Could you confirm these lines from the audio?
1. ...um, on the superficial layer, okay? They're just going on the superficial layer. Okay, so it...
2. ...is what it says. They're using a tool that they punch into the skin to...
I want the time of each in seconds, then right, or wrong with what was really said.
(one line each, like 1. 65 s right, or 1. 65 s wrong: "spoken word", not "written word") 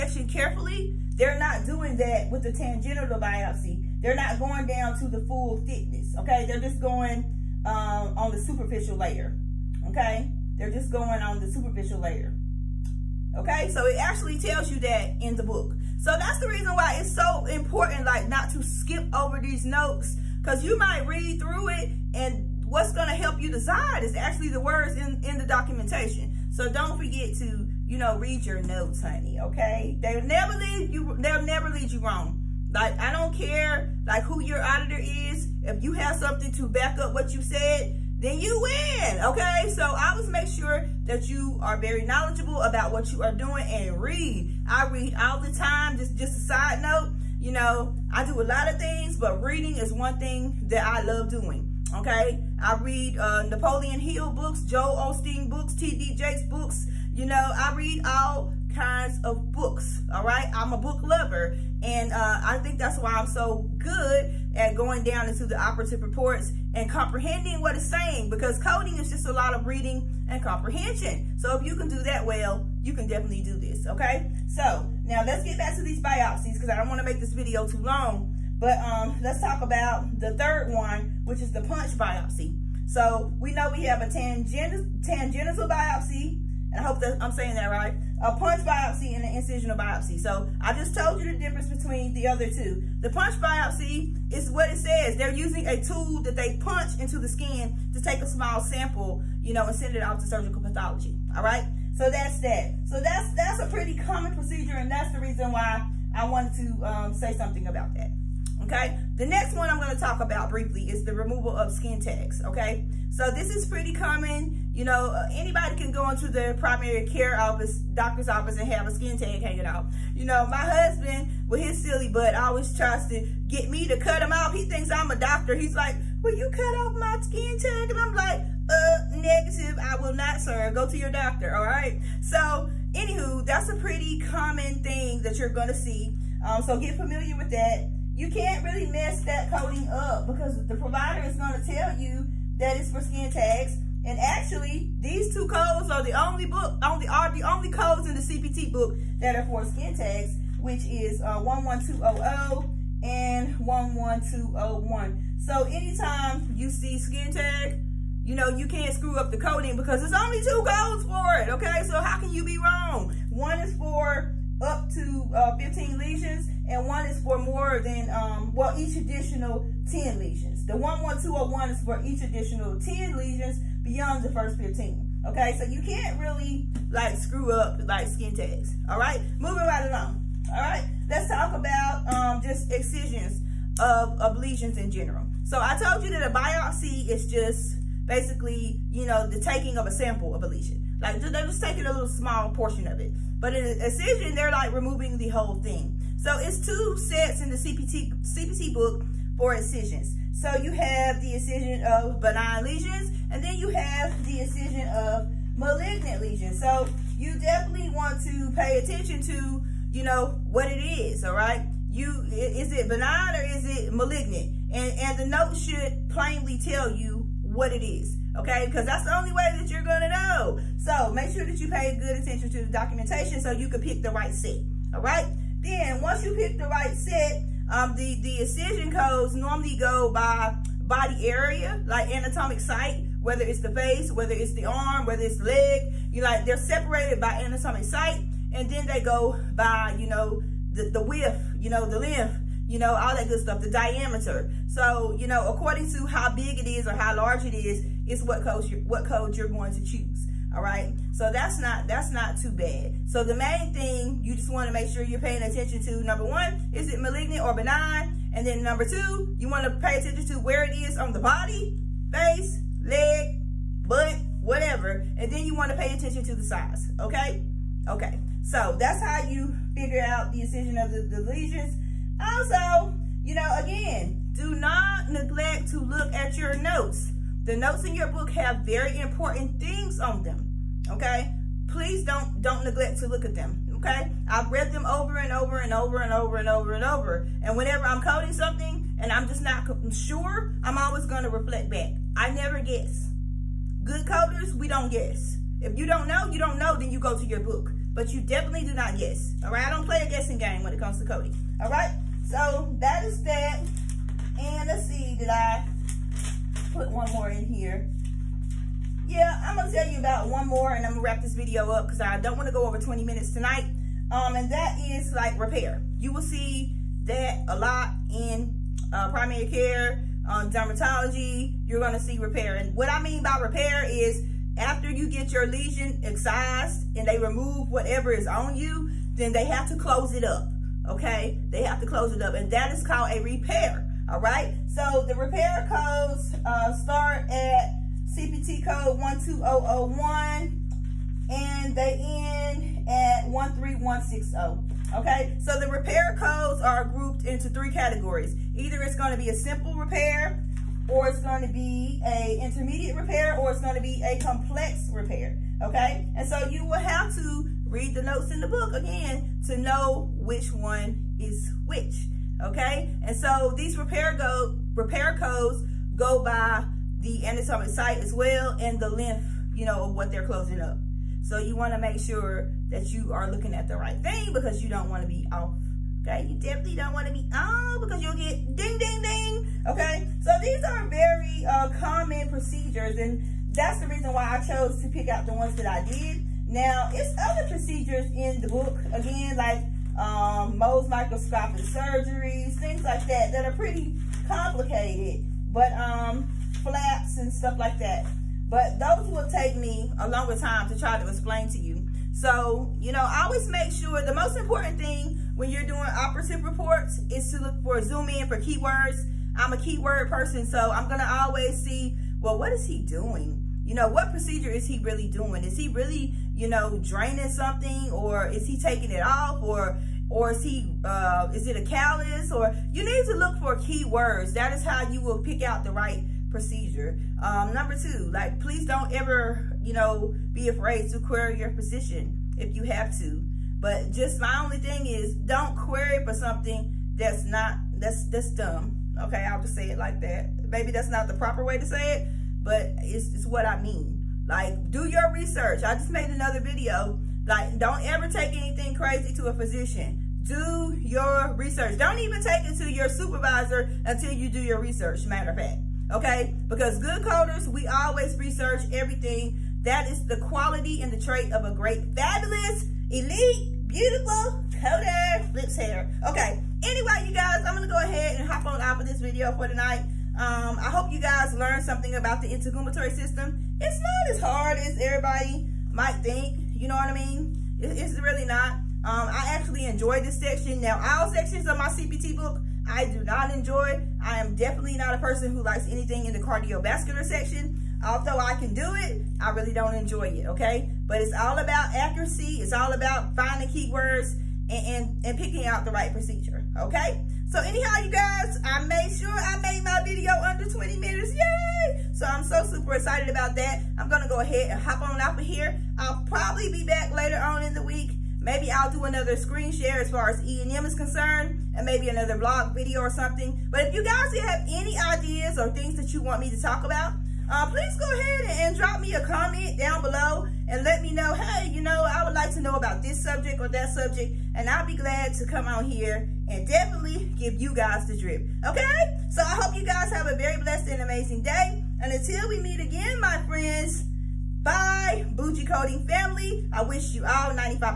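1. 7 s right
2. 94 s right.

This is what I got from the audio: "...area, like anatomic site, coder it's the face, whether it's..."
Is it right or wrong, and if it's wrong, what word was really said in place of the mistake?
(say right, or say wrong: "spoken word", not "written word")
wrong: "whether", not "coder".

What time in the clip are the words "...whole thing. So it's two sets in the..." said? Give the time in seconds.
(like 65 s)
195 s.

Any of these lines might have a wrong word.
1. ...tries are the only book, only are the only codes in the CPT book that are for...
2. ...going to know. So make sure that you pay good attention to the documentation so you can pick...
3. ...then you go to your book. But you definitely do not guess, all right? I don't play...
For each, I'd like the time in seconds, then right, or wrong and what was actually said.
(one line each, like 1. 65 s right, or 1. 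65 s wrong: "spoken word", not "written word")
1. 145 s wrong: "codes", not "tries"
2. 219 s right
3. 296 s right.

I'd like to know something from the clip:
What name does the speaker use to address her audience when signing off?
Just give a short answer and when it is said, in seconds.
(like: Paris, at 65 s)
Bougie Coding family, at 535 s.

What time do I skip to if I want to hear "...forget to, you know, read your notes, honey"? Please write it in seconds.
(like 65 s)
26 s.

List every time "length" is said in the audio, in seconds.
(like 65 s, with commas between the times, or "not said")
241 s, 368 s.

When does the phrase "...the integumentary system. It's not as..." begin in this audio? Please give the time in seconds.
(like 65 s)
472 s.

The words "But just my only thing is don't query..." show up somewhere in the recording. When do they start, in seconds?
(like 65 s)
433 s.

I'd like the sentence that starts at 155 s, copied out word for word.
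So anytime you see skin tag, you know, you can't screw up the coding because there's only two codes for it, okay?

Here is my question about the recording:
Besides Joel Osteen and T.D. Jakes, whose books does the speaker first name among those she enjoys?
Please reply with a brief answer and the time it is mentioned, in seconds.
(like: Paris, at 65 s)
Napoleon Hill, at 53 s.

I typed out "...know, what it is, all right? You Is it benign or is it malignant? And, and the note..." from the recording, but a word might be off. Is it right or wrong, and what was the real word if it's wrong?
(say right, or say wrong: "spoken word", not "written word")
right.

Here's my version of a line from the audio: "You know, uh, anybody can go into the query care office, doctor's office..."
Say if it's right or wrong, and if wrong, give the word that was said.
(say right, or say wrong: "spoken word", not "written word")
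wrong: "primary", not "query".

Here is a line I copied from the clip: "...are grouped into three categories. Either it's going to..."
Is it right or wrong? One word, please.
right.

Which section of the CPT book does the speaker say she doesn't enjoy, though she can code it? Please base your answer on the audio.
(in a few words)
cardiovascular.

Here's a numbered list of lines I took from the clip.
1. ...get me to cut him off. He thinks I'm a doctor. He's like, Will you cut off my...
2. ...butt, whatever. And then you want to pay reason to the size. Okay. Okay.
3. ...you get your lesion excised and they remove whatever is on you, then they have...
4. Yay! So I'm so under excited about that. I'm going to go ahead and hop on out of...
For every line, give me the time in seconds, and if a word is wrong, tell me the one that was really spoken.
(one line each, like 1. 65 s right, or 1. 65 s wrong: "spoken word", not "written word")
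1. 123 s right
2. 263 s wrong: "attention", not "reason"
3. 324 s right
4. 501 s wrong: "super", not "under".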